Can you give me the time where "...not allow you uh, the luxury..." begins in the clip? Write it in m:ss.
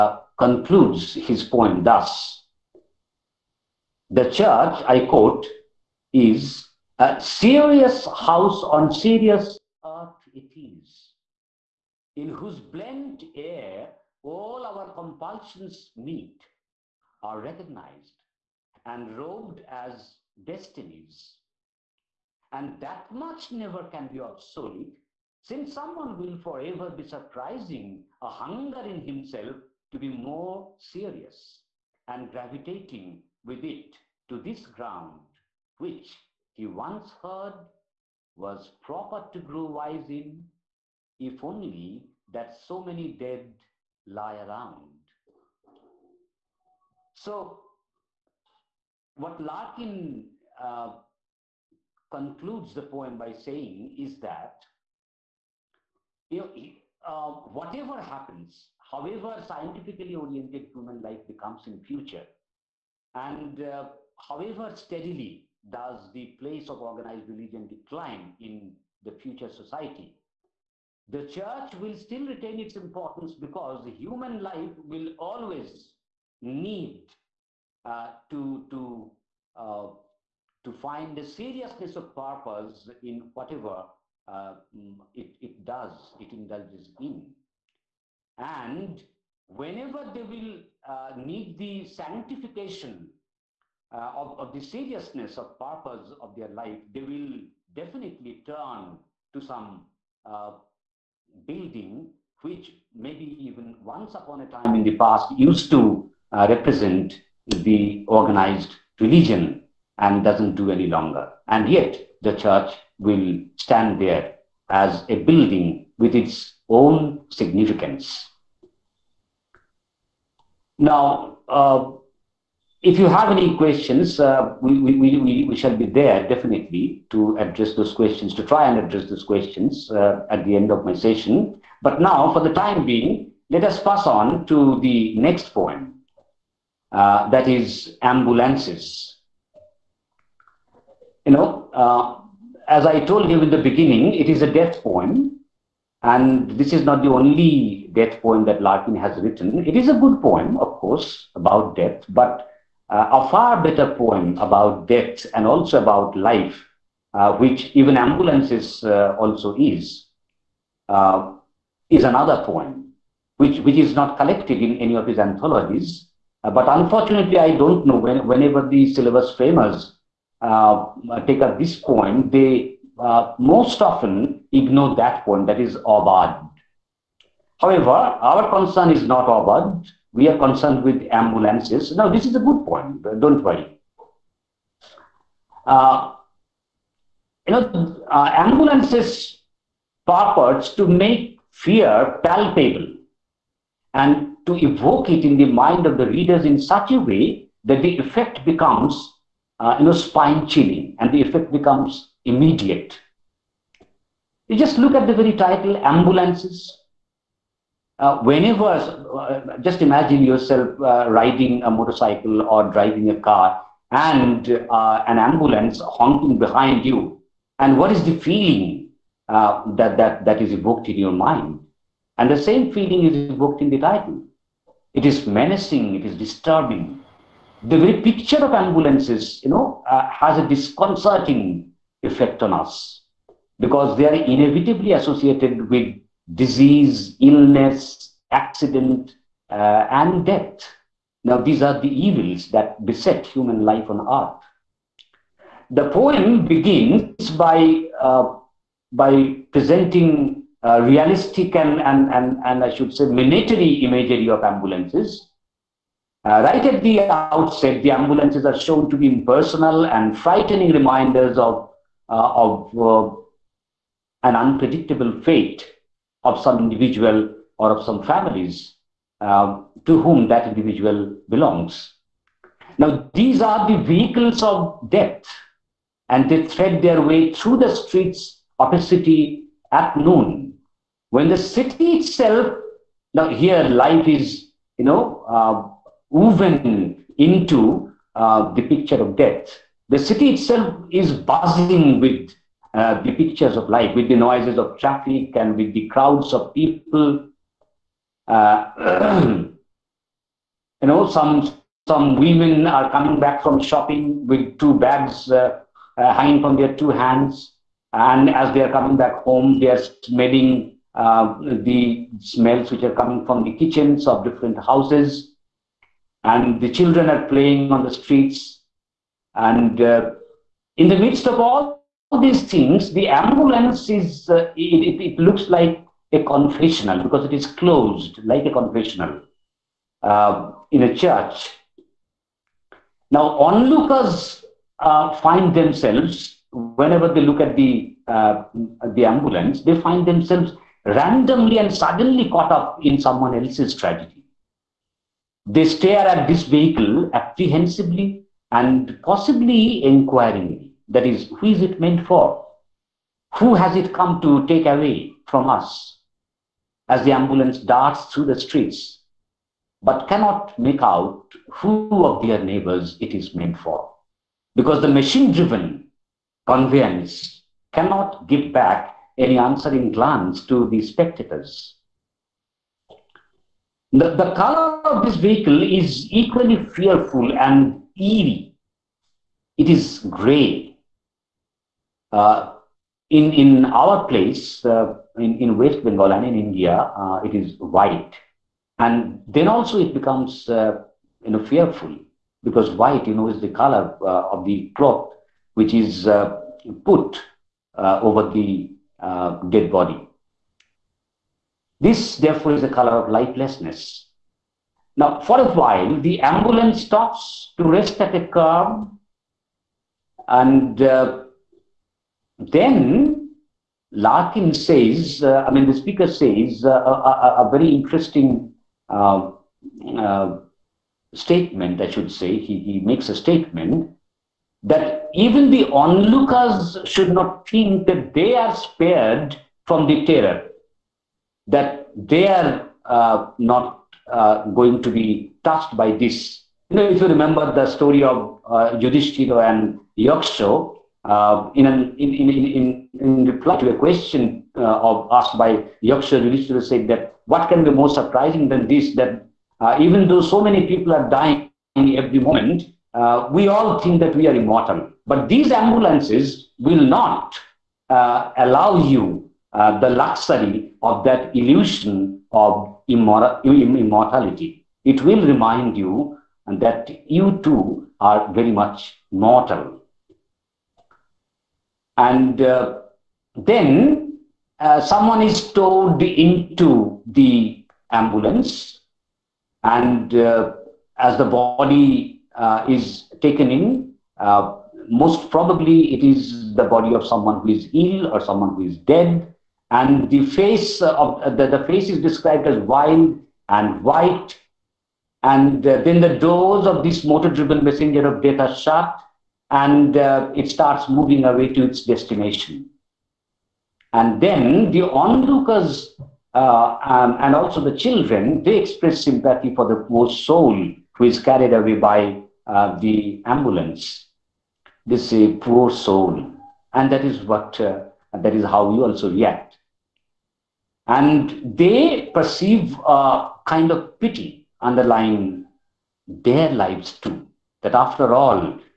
7:36.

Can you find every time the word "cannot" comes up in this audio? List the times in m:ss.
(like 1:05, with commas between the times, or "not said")
6:00, 6:07.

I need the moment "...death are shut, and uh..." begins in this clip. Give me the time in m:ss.
8:18.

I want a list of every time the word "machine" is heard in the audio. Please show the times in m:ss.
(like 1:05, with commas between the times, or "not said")
6:04.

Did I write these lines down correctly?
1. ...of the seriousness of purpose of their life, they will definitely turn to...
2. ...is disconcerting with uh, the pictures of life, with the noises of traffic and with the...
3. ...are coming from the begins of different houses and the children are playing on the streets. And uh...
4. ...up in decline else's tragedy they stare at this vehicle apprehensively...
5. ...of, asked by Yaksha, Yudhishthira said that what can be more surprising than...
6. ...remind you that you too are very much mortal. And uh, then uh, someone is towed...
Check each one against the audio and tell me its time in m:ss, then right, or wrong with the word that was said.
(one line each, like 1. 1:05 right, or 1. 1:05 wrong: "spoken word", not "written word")
1. 1:34 right
2. 4:50 wrong: "buzzing", not "disconcerting"
3. 5:12 wrong: "kitchens", not "begins"
4. 5:42 wrong: "someone", not "decline"
5. 7:24 right
6. 7:45 right.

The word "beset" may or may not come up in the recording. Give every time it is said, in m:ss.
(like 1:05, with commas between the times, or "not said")
4:02.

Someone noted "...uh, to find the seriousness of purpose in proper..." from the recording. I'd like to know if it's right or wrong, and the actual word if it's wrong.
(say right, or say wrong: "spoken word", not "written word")
wrong: "whatever", not "proper".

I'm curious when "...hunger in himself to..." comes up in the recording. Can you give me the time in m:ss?
0:28.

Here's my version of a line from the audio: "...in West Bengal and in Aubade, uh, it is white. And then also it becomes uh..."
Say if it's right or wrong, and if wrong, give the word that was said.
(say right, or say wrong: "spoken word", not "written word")
wrong: "India", not "Aubade".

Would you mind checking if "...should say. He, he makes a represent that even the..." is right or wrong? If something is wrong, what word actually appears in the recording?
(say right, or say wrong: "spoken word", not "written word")
wrong: "statement", not "represent".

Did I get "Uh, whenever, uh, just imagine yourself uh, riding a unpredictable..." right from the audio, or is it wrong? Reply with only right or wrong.
wrong.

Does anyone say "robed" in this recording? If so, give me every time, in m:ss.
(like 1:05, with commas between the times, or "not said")
0:19.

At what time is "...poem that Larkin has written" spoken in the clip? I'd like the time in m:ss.
2:28.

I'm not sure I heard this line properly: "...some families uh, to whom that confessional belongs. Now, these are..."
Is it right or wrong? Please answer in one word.
wrong.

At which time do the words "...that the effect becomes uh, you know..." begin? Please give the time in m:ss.
3:17.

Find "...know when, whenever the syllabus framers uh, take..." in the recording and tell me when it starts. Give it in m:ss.
2:47.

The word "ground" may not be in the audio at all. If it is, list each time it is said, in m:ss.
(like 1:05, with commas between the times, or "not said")
0:34.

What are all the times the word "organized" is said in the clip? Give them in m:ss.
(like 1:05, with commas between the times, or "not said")
1:06, 1:48.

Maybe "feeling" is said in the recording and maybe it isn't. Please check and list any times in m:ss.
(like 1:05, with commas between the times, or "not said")
3:38, 3:42.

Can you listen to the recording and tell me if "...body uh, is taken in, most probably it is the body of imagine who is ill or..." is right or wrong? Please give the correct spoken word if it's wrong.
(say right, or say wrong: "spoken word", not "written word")
wrong: "someone", not "imagine".